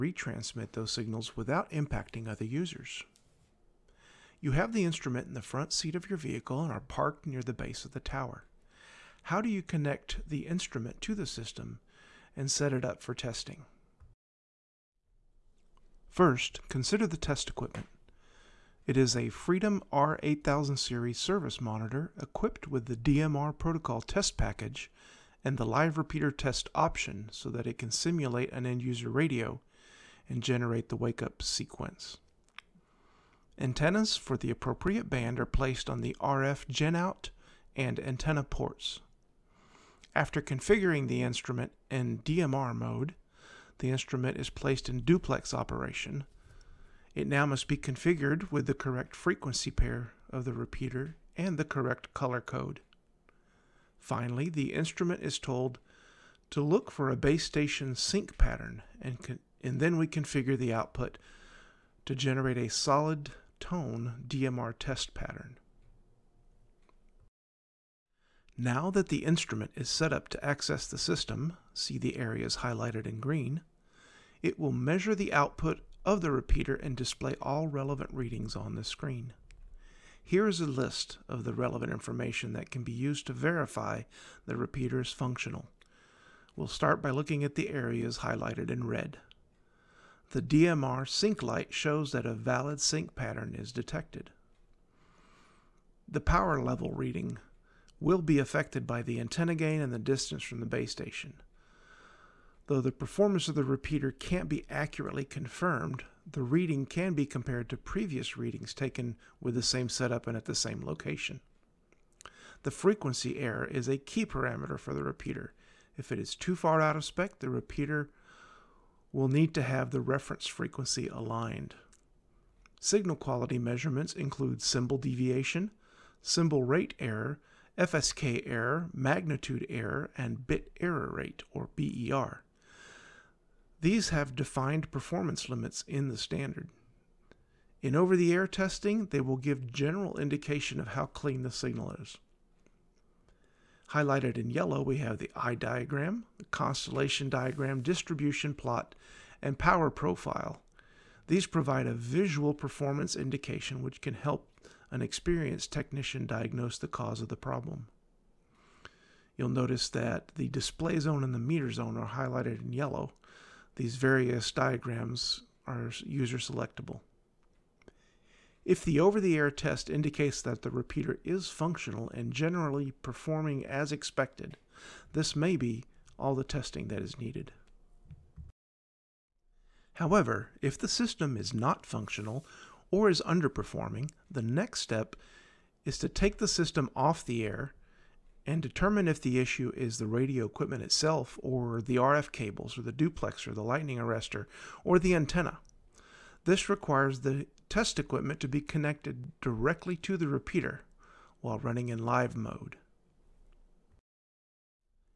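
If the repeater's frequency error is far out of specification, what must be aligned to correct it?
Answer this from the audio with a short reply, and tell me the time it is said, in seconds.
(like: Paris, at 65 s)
reference frequency, at 119 s.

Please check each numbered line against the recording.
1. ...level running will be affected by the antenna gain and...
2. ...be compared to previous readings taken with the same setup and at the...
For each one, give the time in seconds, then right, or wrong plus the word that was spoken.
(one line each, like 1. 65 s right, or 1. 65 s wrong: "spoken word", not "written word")
1. 96 s wrong: "reading", not "running"
2. 107 s right.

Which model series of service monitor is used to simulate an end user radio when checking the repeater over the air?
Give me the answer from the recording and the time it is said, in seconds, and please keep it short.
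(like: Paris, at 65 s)
Freedom R8000, at 19 s.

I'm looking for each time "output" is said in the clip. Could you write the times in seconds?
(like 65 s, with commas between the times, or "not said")
60 s, 75 s.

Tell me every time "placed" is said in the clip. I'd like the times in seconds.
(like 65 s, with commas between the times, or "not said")
35 s, 44 s.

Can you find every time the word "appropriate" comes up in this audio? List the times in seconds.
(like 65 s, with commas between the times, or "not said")
34 s.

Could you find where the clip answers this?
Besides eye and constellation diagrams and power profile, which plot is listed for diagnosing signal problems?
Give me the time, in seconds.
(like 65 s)
147 s.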